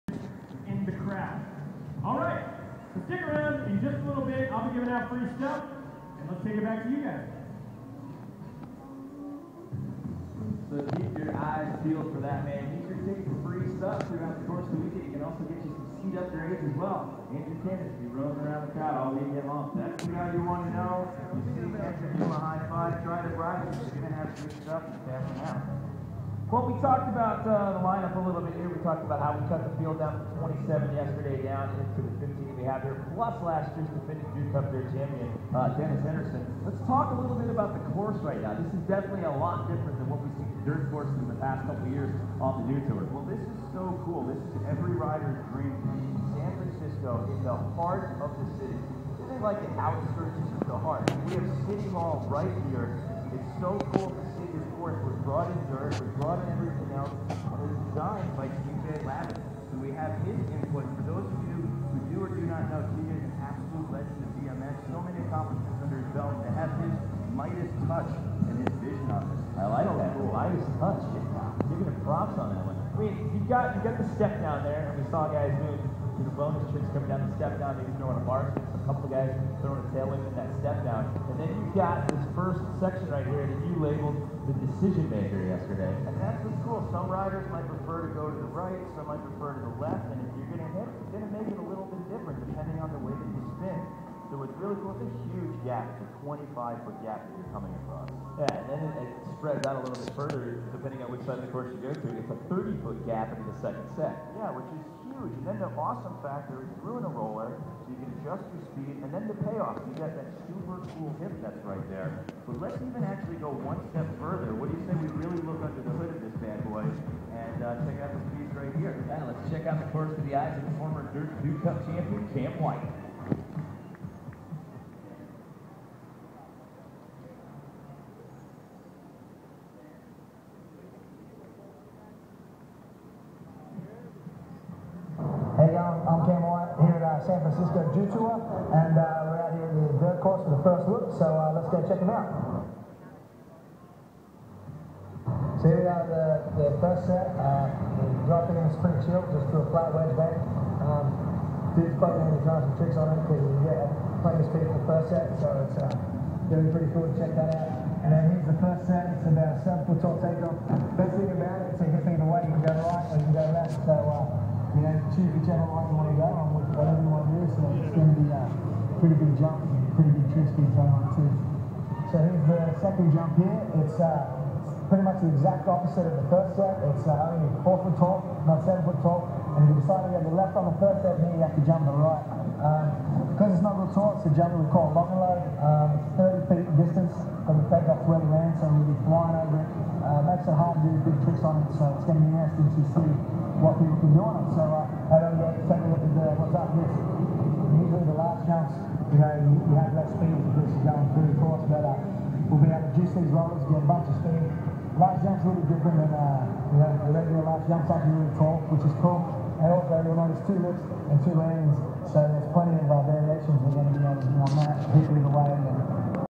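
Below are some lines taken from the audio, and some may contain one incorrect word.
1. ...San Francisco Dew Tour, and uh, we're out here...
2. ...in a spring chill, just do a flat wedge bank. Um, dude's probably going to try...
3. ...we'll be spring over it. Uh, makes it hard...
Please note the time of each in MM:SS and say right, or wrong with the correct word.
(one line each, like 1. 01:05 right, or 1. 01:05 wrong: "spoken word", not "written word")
1. 02:17 right
2. 02:28 right
3. 03:08 wrong: "flying", not "spring".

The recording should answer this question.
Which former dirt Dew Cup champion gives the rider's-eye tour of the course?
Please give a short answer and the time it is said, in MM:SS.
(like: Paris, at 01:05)
Cam White, at 02:02.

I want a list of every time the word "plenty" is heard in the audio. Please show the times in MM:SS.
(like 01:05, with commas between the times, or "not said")
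02:34, 03:32.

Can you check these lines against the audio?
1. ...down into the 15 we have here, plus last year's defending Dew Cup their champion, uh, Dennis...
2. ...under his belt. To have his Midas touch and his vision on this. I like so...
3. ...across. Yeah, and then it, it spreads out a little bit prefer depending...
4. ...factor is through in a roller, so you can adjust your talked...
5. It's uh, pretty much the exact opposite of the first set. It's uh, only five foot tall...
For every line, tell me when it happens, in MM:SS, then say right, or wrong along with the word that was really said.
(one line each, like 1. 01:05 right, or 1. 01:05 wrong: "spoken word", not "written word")
1. 00:31 right
2. 01:05 right
3. 01:37 wrong: "further", not "prefer"
4. 01:46 wrong: "speed", not "talked"
5. 02:53 wrong: "four", not "five".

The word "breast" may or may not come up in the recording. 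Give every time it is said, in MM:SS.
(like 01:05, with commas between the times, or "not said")
not said.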